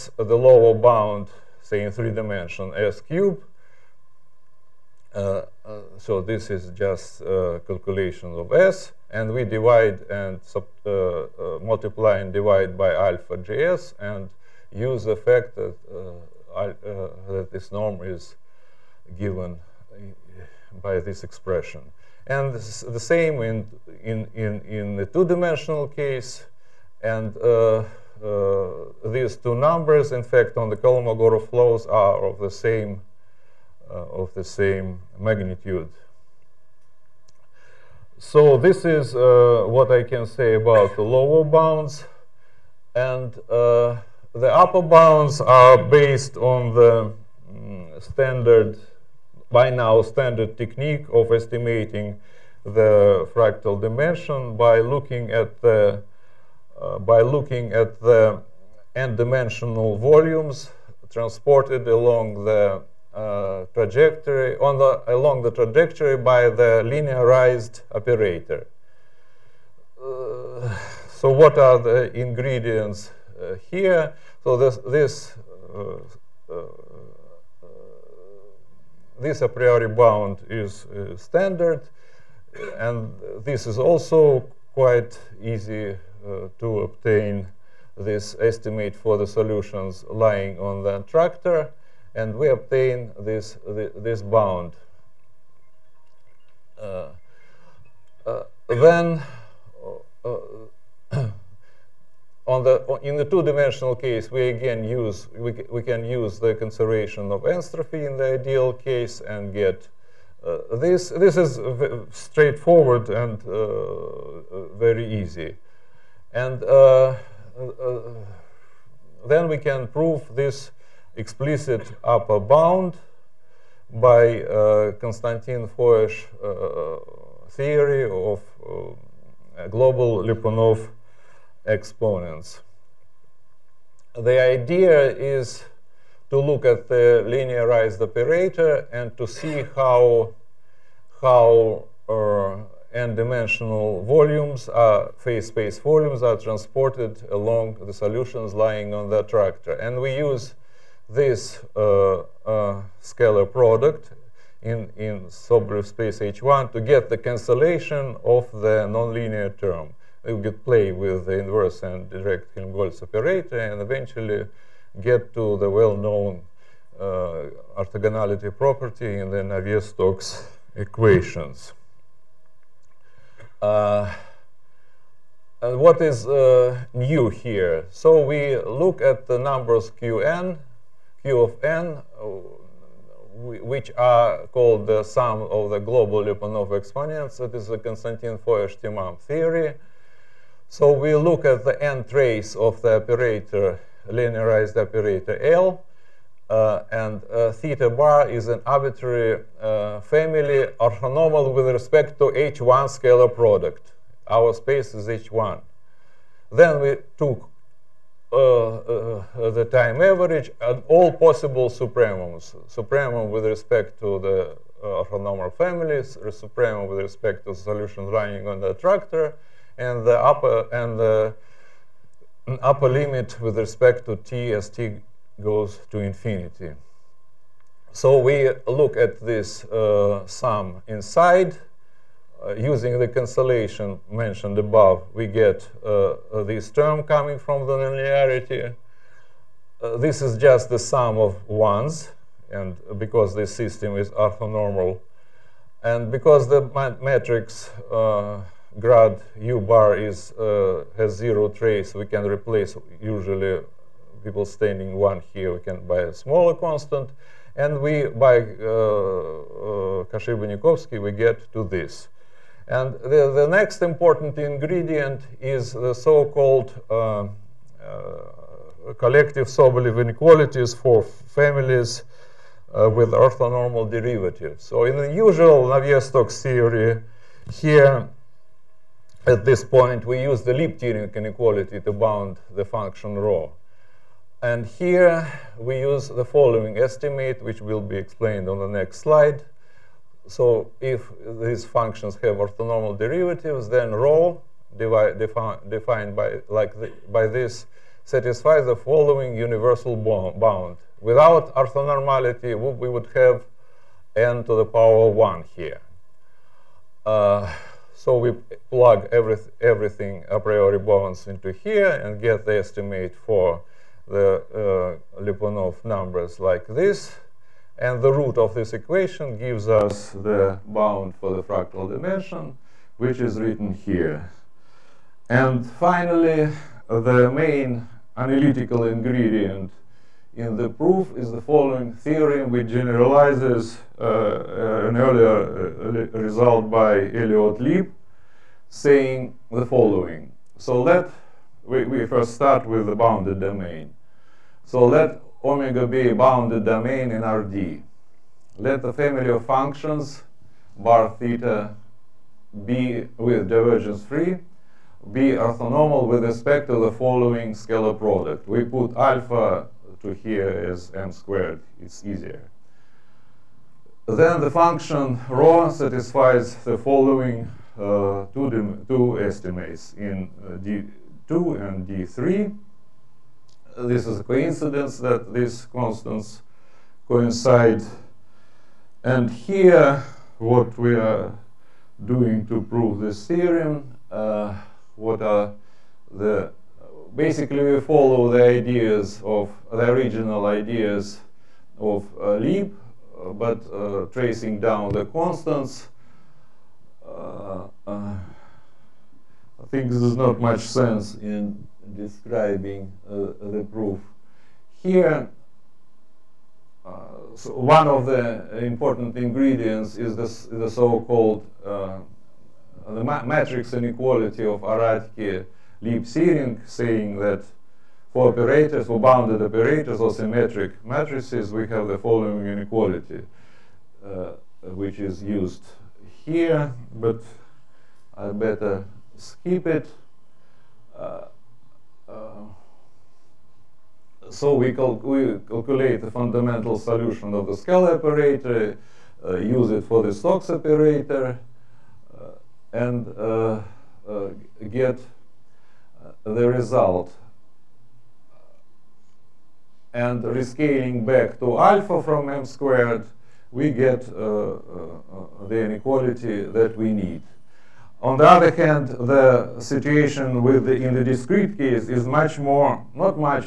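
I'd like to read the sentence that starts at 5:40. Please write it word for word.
So let, we, we first start with the bounded domain.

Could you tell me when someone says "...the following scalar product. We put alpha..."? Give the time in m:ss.
5:56.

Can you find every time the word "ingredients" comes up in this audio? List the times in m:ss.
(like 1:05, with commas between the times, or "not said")
1:12, 4:24, 5:28, 6:49.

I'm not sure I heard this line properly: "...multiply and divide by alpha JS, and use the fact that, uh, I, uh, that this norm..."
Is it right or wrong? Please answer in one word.
right.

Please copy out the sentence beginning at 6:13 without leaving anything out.
This is a coincidence that these constants coincide.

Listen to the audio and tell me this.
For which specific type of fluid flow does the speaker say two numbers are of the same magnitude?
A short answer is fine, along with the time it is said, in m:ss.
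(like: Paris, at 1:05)
Kolmogorov flows, at 0:30.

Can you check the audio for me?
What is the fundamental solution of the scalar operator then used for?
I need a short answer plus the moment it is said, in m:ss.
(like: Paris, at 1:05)
Stokes operator, at 7:20.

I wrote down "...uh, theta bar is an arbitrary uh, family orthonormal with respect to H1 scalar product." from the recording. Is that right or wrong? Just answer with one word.
right.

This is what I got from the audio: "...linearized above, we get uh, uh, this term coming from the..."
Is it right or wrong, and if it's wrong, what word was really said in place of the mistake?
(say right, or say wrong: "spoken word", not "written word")
wrong: "mentioned", not "linearized".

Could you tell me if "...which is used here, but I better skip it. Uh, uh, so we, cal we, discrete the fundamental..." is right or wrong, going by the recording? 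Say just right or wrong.
wrong.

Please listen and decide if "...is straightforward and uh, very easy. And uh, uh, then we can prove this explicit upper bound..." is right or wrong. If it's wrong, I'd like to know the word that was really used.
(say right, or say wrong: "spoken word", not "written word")
right.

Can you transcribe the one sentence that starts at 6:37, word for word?
Uh, uh, I think this is not much sense in describing uh, the proof.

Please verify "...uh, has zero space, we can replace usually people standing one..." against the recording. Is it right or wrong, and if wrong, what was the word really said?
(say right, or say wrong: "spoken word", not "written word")
wrong: "trace", not "space".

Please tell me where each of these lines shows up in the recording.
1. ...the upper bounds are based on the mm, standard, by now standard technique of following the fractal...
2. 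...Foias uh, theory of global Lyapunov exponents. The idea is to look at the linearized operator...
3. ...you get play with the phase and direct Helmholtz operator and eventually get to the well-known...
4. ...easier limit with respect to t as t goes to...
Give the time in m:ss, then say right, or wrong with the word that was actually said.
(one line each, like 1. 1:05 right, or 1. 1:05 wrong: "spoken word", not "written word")
1. 0:44 wrong: "estimating", not "following"
2. 2:05 right
3. 2:40 wrong: "inverse", not "phase"
4. 3:42 wrong: "upper", not "easier".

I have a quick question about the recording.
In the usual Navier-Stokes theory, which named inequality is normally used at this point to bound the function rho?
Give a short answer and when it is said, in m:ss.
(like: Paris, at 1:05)
Lieb-Thirring inequality, at 4:40.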